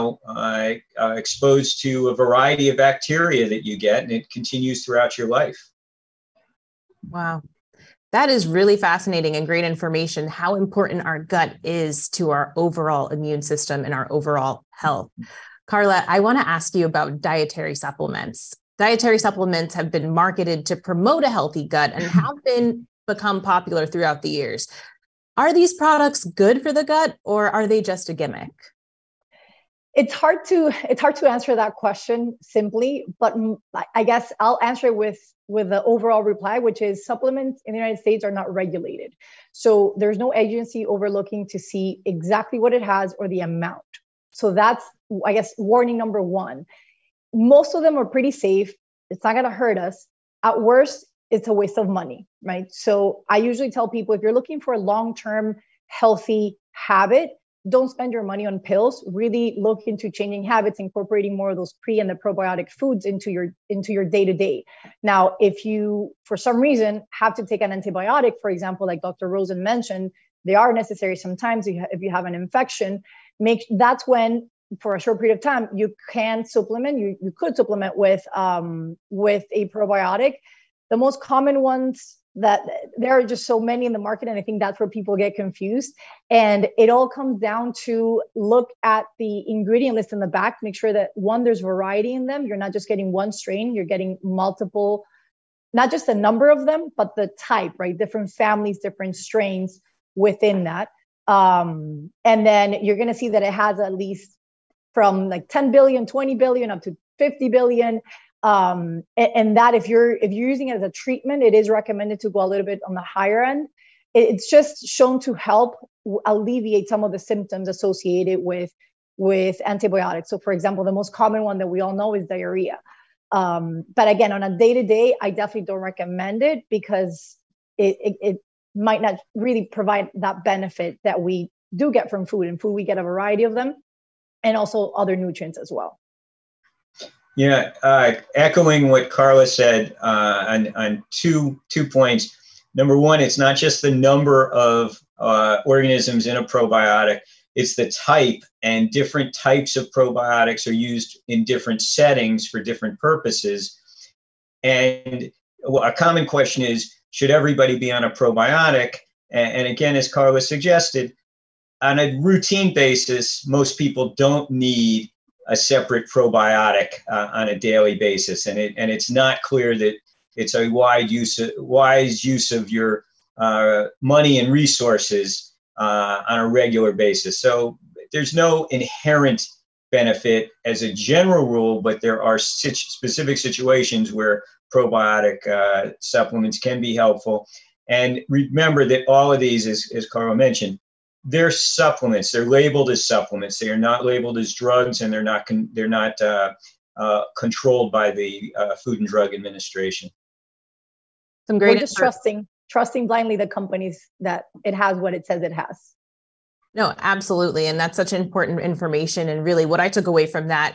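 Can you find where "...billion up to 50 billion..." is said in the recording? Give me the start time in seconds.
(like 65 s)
106 s.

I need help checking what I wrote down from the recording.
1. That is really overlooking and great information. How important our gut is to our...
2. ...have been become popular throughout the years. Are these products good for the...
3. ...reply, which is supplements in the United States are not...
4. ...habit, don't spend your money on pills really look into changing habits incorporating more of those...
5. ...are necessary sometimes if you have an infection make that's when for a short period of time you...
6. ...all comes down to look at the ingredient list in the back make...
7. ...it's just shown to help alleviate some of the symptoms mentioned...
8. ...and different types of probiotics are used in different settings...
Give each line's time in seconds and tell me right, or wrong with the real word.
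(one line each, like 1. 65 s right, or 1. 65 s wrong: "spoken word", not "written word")
1. 8 s wrong: "fascinating", not "overlooking"
2. 22 s right
3. 36 s right
4. 56 s right
5. 70 s right
6. 86 s right
7. 114 s wrong: "associated", not "mentioned"
8. 148 s right.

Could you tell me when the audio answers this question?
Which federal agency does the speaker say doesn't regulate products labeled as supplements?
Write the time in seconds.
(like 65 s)
198 s.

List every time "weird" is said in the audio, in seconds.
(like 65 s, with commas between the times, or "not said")
not said.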